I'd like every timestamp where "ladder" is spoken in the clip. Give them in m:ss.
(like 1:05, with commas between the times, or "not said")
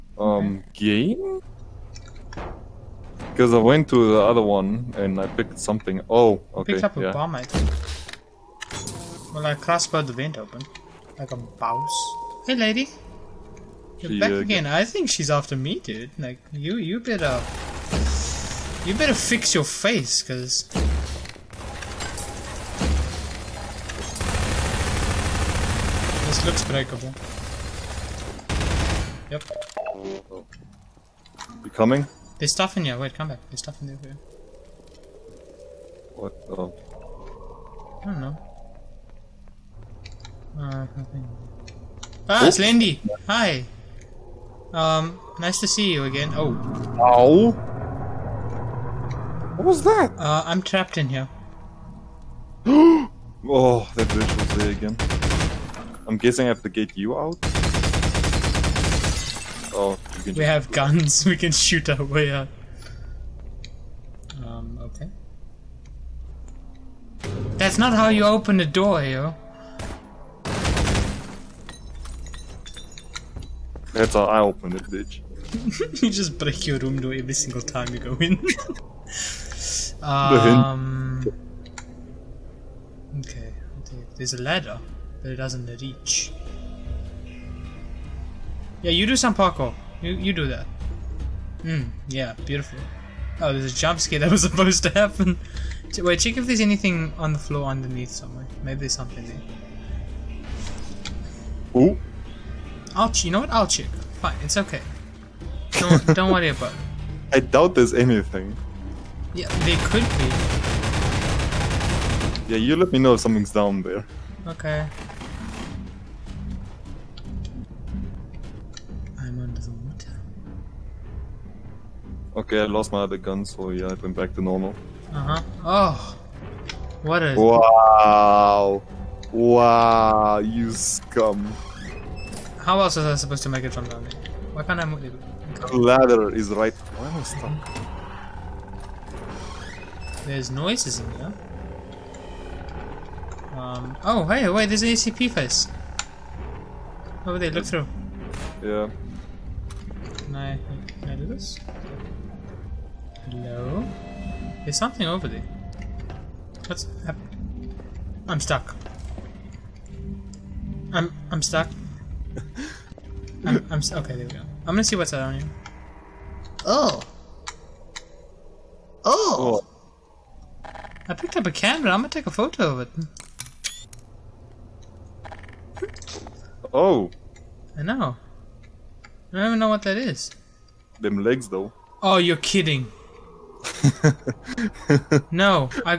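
1:24, 2:15.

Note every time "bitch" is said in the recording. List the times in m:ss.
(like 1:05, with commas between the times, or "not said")
0:54, 1:14.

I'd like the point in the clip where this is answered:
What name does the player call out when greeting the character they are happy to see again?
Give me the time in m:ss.
0:42.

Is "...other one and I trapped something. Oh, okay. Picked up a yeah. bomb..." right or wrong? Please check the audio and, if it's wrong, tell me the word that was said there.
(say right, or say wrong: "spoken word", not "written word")
wrong: "picked", not "trapped".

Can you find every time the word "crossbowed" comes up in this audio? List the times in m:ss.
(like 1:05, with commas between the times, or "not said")
0:09.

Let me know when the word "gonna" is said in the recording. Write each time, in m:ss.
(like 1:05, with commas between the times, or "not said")
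2:44, 2:51.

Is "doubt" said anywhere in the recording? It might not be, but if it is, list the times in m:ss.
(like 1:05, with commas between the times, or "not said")
1:47.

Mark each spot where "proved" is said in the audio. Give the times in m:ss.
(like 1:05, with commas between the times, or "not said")
not said.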